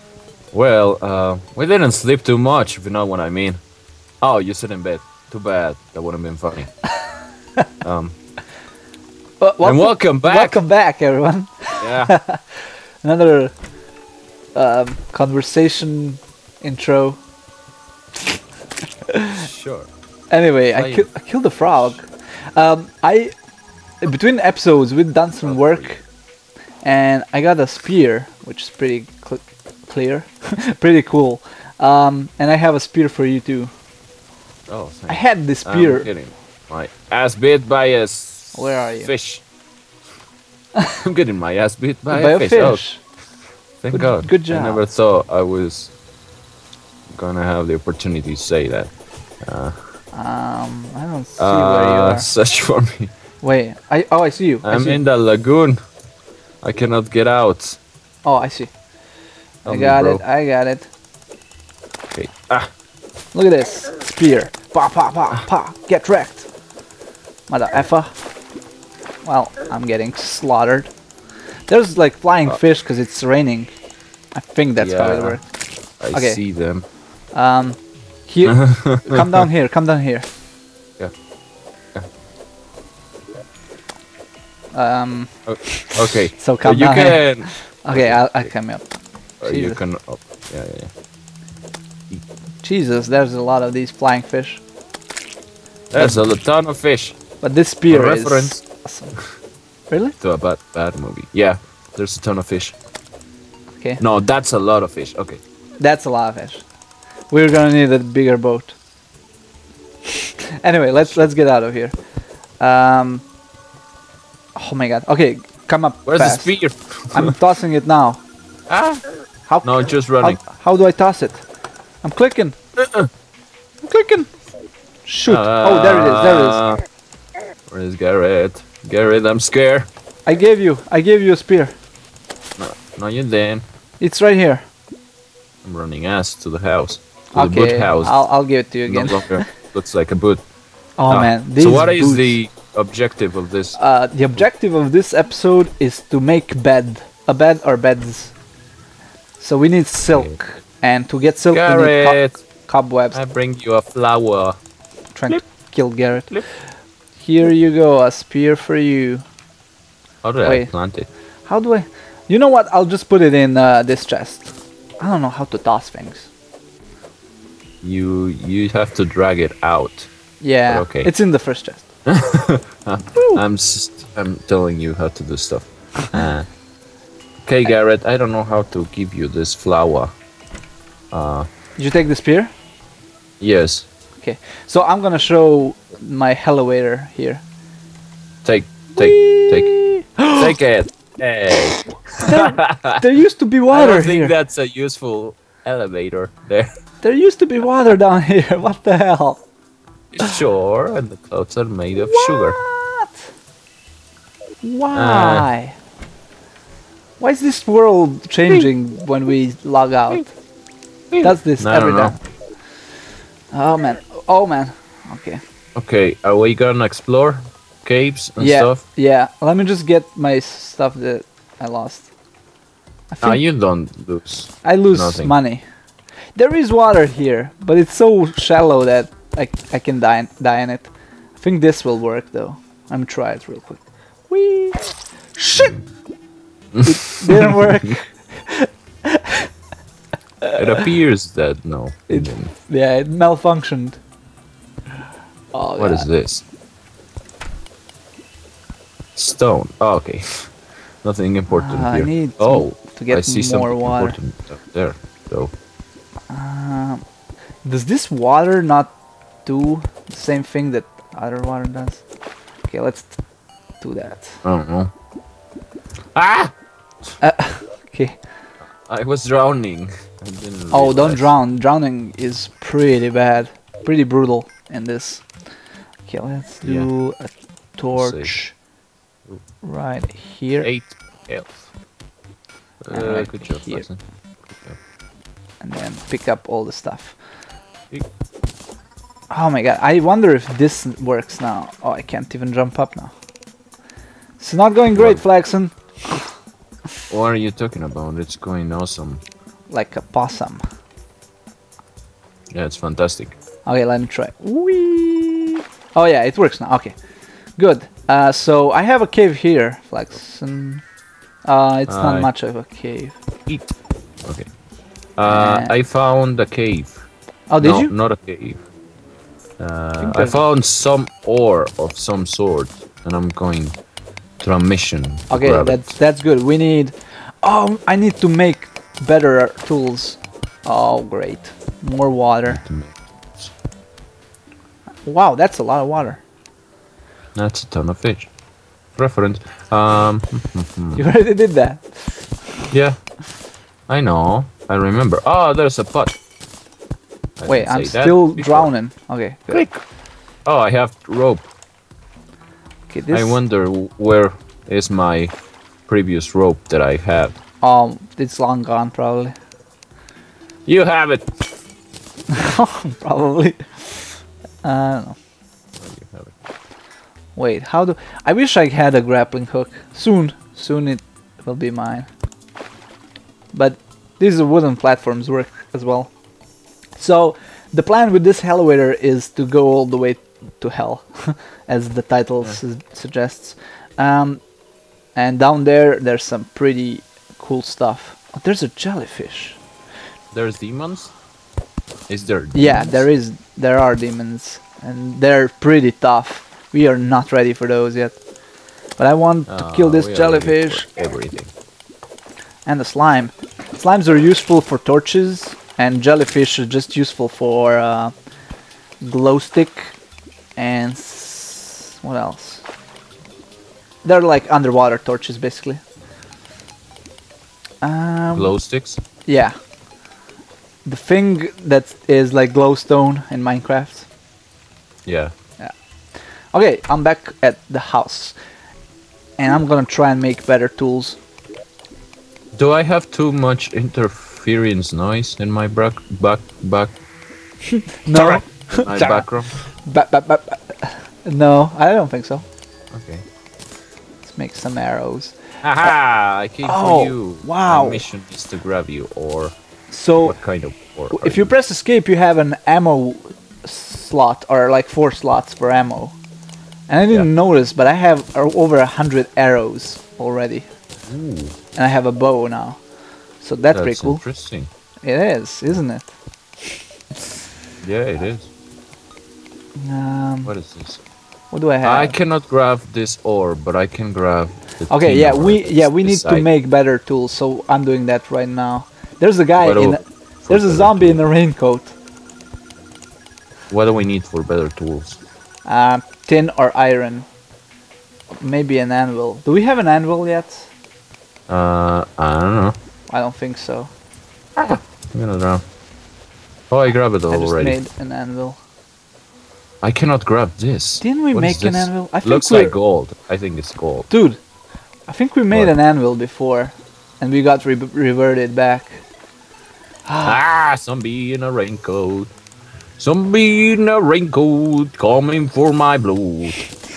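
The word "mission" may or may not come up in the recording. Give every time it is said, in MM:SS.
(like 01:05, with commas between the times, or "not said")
05:24, 07:27.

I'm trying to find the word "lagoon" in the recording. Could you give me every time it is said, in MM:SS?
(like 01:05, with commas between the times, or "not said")
00:55.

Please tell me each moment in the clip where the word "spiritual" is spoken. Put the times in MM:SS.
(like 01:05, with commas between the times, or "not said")
not said.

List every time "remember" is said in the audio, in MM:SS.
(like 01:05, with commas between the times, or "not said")
05:44.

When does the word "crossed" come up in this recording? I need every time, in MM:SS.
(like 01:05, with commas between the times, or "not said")
not said.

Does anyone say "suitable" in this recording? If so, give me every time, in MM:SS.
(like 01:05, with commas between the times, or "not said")
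not said.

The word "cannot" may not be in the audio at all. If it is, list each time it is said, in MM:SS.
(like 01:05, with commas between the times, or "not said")
00:56, 07:52, 08:19.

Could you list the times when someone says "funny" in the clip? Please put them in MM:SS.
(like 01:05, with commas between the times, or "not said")
00:06.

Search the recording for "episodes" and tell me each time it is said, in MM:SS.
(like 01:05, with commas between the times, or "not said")
00:24, 02:25.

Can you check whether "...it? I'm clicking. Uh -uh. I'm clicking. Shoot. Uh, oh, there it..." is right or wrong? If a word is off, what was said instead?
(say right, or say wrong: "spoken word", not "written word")
right.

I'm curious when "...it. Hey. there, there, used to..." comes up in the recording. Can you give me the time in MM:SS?
03:10.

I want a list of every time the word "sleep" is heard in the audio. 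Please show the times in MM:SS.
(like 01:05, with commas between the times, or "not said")
00:01.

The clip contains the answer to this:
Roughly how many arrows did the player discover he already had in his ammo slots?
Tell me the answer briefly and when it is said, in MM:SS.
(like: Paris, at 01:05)
Over 100, at 07:38.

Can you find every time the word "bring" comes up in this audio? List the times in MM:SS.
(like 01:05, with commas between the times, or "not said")
02:33.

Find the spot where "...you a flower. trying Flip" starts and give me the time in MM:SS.
02:33.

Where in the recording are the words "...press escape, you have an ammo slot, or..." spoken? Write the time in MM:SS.
07:31.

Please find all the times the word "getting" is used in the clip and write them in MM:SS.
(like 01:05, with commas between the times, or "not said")
00:36, 00:41, 01:09.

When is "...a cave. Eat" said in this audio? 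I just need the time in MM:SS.
05:12.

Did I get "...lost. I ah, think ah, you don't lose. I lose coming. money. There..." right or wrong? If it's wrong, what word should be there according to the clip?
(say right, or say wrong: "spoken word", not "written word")
wrong: "nothing", not "coming".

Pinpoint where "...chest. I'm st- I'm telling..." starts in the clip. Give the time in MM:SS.
02:51.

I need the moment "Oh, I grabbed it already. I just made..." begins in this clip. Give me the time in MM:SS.
08:16.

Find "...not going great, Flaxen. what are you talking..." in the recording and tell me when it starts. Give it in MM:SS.
04:54.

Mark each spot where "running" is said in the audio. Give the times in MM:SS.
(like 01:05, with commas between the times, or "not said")
02:00, 02:15.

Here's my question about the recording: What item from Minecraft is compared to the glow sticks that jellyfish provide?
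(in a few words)
Glowstone.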